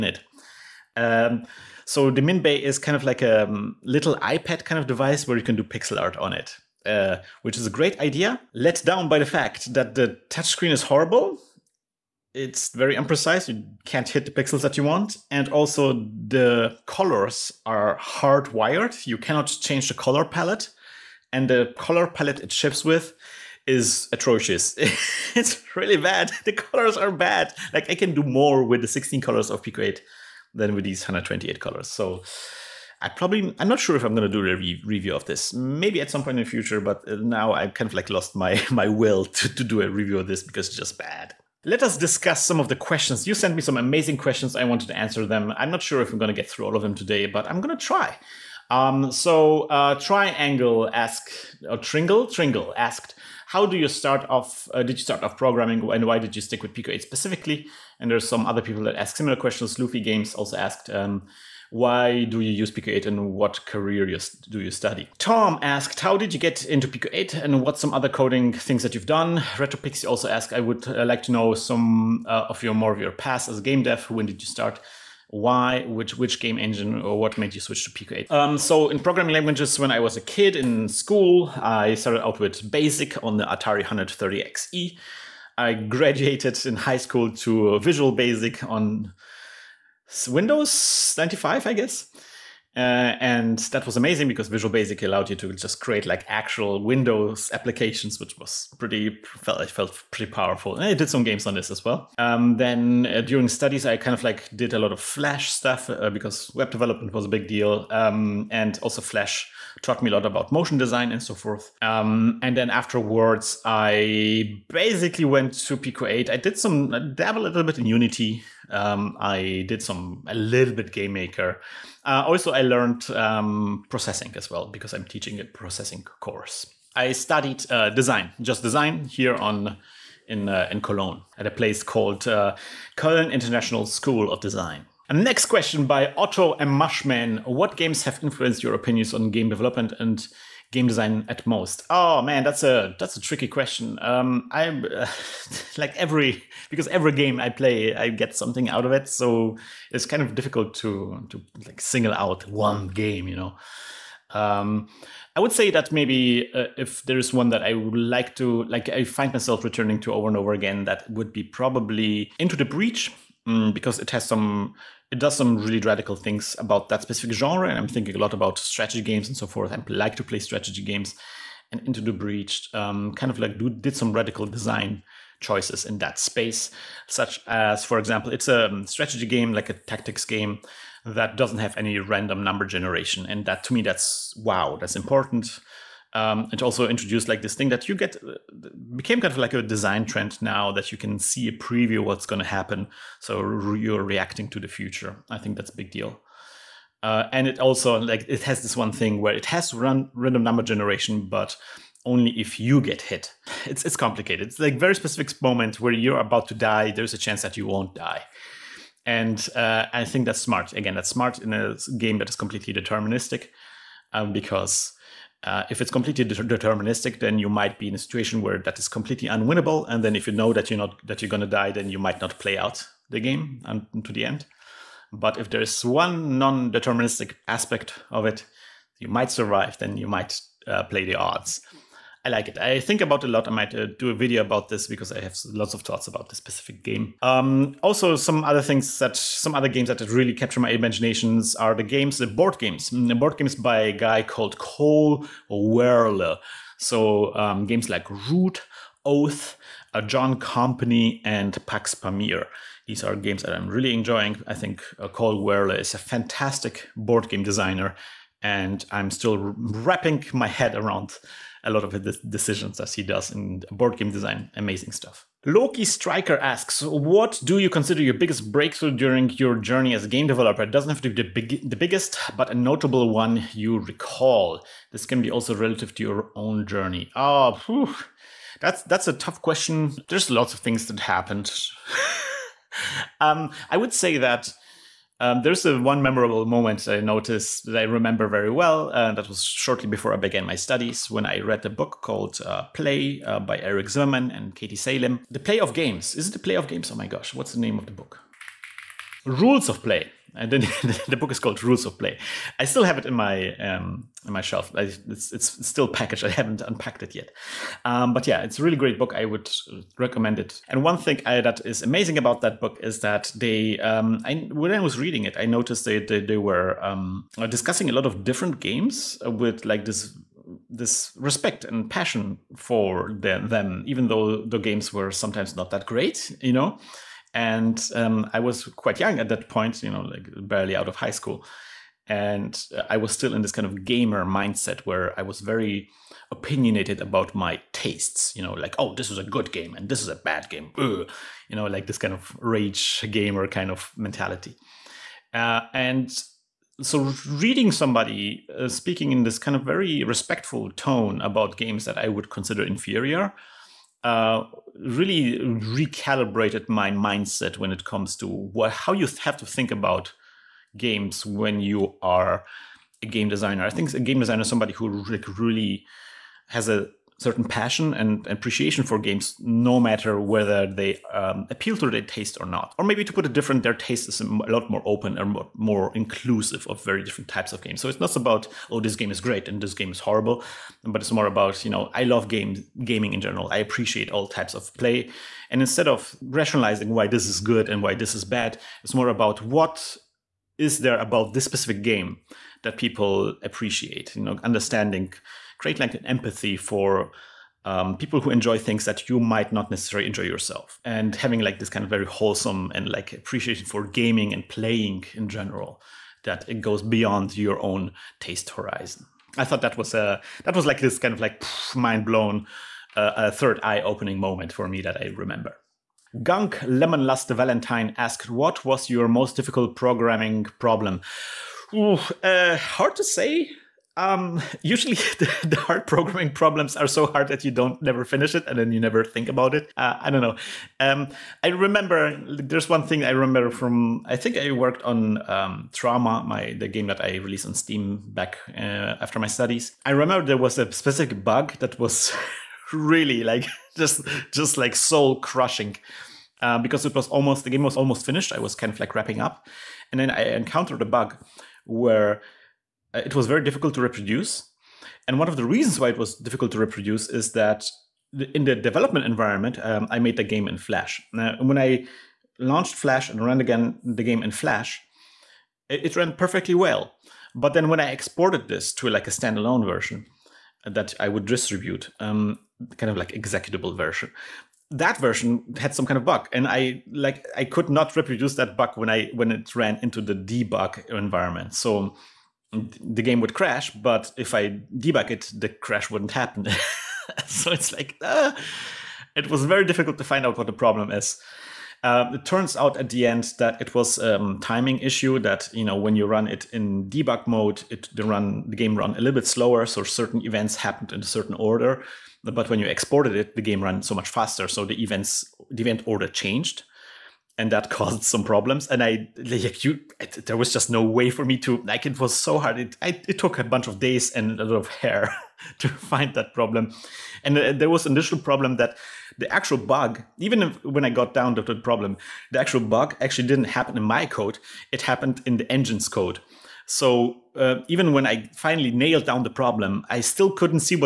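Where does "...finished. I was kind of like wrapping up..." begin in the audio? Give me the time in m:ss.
7:28.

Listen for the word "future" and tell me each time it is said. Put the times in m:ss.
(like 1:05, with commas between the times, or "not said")
0:36, 3:14.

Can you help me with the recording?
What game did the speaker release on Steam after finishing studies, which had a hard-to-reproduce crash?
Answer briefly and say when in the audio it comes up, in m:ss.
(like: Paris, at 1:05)
Trauma, at 7:15.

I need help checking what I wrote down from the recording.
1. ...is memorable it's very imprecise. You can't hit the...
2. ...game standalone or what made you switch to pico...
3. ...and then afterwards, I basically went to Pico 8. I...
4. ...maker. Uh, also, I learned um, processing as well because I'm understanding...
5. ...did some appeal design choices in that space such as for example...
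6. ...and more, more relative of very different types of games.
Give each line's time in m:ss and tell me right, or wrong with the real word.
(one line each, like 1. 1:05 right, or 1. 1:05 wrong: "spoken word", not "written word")
1. 0:10 wrong: "horrible", not "memorable"
2. 1:16 wrong: "engine", not "standalone"
3. 1:52 right
4. 2:01 wrong: "teaching", not "understanding"
5. 2:53 wrong: "radical", not "appeal"
6. 6:15 wrong: "inclusive", not "relative".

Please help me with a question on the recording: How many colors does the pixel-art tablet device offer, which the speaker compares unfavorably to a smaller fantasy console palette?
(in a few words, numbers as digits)
128.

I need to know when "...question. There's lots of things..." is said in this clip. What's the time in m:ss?
4:39.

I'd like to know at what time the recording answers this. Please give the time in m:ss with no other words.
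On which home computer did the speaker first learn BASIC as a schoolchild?
1:23.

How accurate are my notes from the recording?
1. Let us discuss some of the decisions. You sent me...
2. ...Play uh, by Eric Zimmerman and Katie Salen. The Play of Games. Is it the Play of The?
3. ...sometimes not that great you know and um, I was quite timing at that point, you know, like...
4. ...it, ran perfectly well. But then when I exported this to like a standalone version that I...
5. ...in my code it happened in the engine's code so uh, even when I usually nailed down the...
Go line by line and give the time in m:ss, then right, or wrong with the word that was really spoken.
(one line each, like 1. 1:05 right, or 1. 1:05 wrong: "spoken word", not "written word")
1. 0:41 wrong: "questions", not "decisions"
2. 4:52 wrong: "Games", not "The"
3. 5:25 wrong: "young", not "timing"
4. 7:45 right
5. 8:43 wrong: "finally", not "usually".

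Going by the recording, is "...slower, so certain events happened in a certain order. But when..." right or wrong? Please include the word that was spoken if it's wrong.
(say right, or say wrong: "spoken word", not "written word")
right.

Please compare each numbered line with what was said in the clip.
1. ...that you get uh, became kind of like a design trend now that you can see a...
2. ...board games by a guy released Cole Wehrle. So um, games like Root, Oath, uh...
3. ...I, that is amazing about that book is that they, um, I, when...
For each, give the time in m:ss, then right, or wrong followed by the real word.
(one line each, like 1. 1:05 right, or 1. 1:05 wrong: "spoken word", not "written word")
1. 3:07 right
2. 4:03 wrong: "called", not "released"
3. 5:11 right.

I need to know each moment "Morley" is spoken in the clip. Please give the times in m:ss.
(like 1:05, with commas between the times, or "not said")
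not said.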